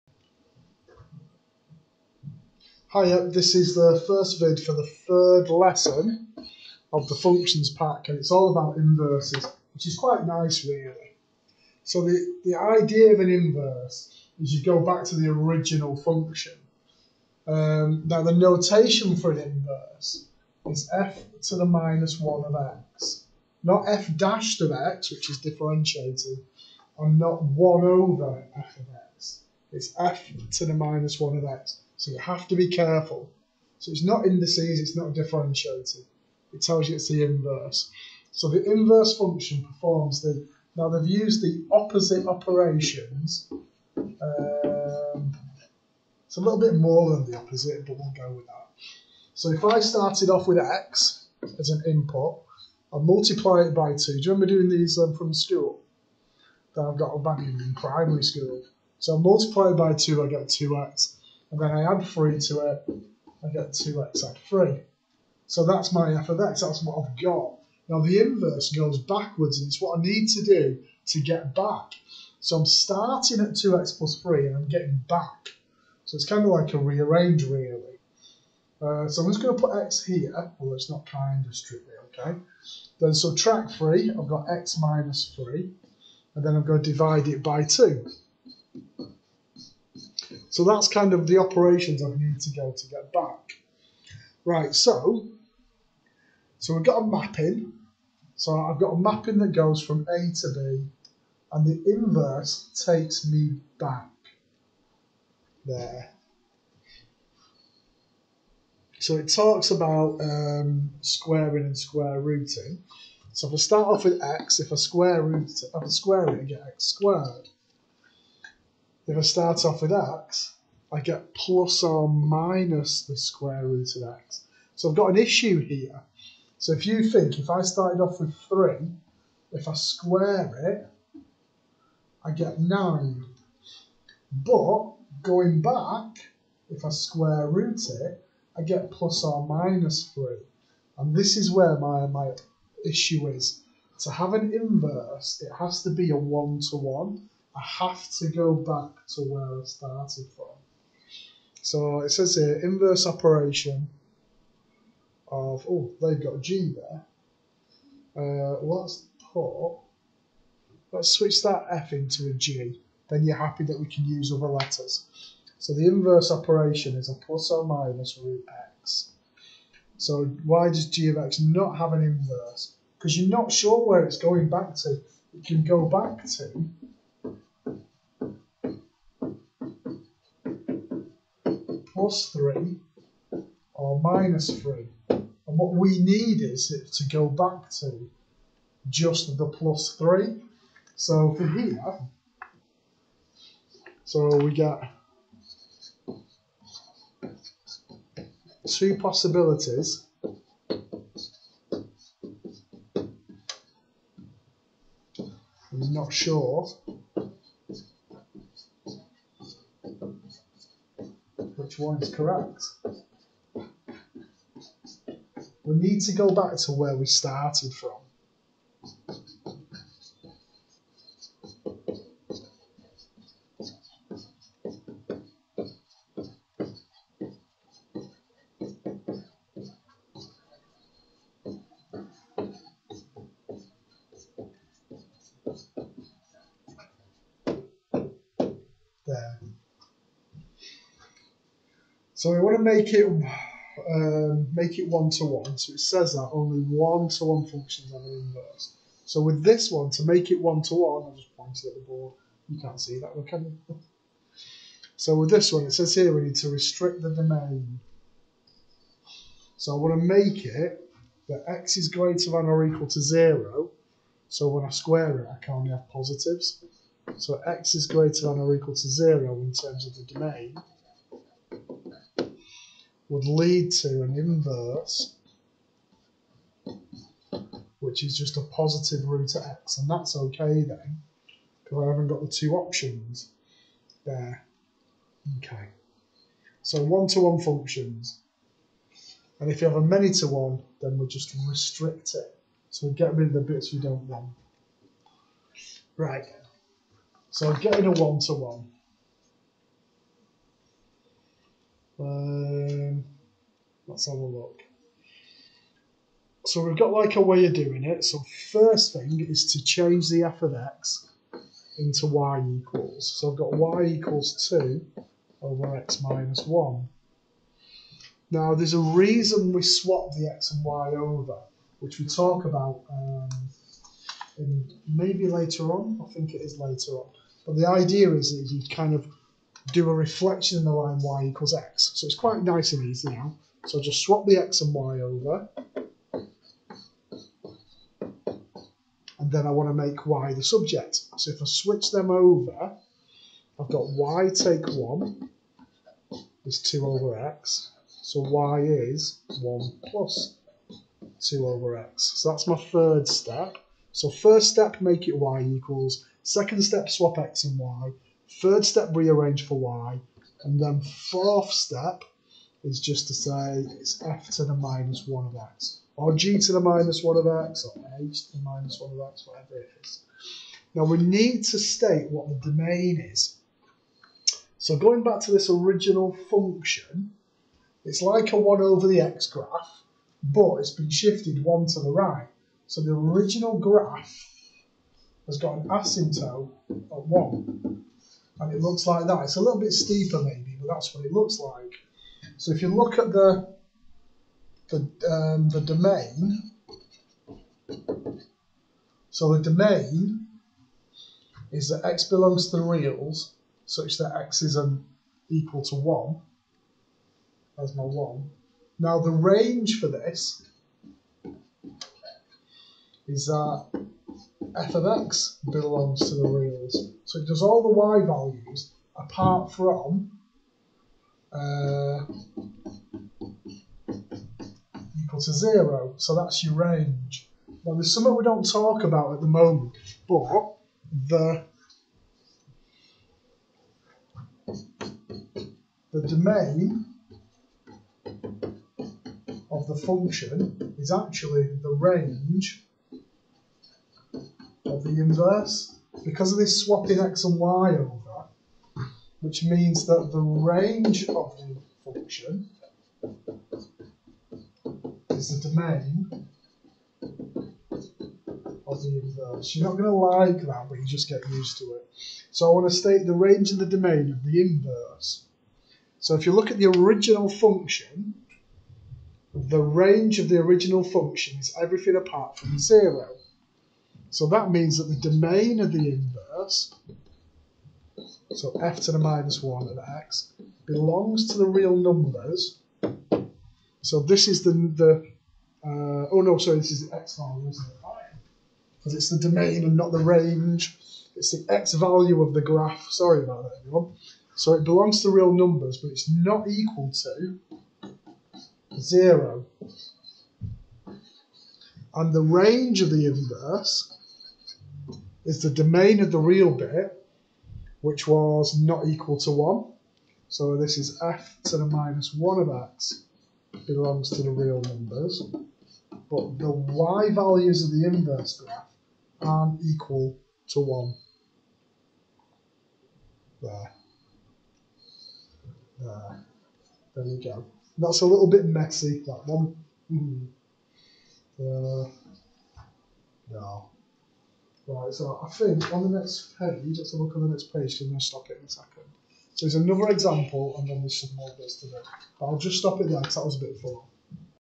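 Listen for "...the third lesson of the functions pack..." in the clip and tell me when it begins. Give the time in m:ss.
0:04.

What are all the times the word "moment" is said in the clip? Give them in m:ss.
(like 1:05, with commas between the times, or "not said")
7:09.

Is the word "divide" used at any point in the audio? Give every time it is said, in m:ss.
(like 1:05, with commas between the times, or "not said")
1:26.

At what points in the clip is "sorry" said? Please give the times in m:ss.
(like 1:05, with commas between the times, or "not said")
8:06, 8:12.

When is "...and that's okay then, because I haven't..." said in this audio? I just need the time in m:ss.
4:39.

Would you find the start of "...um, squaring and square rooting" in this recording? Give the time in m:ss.
1:50.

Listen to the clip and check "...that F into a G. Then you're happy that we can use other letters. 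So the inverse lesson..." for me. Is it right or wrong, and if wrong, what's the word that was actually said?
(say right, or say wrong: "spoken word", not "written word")
wrong: "operation", not "lesson".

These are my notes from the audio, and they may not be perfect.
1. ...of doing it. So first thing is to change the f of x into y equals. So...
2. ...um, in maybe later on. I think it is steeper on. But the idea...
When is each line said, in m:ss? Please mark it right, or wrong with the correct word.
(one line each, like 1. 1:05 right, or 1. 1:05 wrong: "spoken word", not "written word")
1. 5:07 right
2. 5:22 wrong: "later", not "steeper".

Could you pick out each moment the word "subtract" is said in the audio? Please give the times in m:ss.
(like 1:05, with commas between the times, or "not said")
1:23.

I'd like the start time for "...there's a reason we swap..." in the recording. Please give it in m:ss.
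5:18.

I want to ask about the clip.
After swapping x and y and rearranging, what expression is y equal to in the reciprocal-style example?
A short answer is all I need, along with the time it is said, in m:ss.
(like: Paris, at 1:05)
1 plus 2 over x, at 5:49.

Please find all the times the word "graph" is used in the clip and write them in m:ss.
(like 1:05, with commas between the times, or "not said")
6:19, 6:23, 8:12, 8:38.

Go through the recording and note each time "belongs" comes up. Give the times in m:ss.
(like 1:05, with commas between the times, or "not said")
6:42, 6:55, 8:00, 8:14, 8:33.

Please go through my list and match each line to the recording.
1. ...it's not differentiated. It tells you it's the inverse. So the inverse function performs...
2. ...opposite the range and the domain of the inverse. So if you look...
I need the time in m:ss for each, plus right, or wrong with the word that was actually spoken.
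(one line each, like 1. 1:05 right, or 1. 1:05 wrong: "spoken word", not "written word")
1. 0:34 right
2. 7:42 wrong: "state", not "opposite".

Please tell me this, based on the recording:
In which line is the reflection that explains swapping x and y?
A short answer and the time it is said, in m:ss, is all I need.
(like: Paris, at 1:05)
y equals x, at 5:31.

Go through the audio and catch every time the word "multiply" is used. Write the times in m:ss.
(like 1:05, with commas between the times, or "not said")
0:52, 0:59.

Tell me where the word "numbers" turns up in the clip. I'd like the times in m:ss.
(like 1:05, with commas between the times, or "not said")
8:01, 8:15, 8:34.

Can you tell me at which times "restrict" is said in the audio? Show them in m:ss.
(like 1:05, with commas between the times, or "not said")
4:16, 4:51.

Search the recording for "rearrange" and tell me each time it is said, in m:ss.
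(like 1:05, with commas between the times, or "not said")
1:16, 5:58.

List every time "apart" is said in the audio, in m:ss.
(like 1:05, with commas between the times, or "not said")
6:58, 7:51.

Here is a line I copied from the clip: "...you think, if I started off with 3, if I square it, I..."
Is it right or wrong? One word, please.
right.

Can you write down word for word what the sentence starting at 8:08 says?
Because it's the domain and not the range.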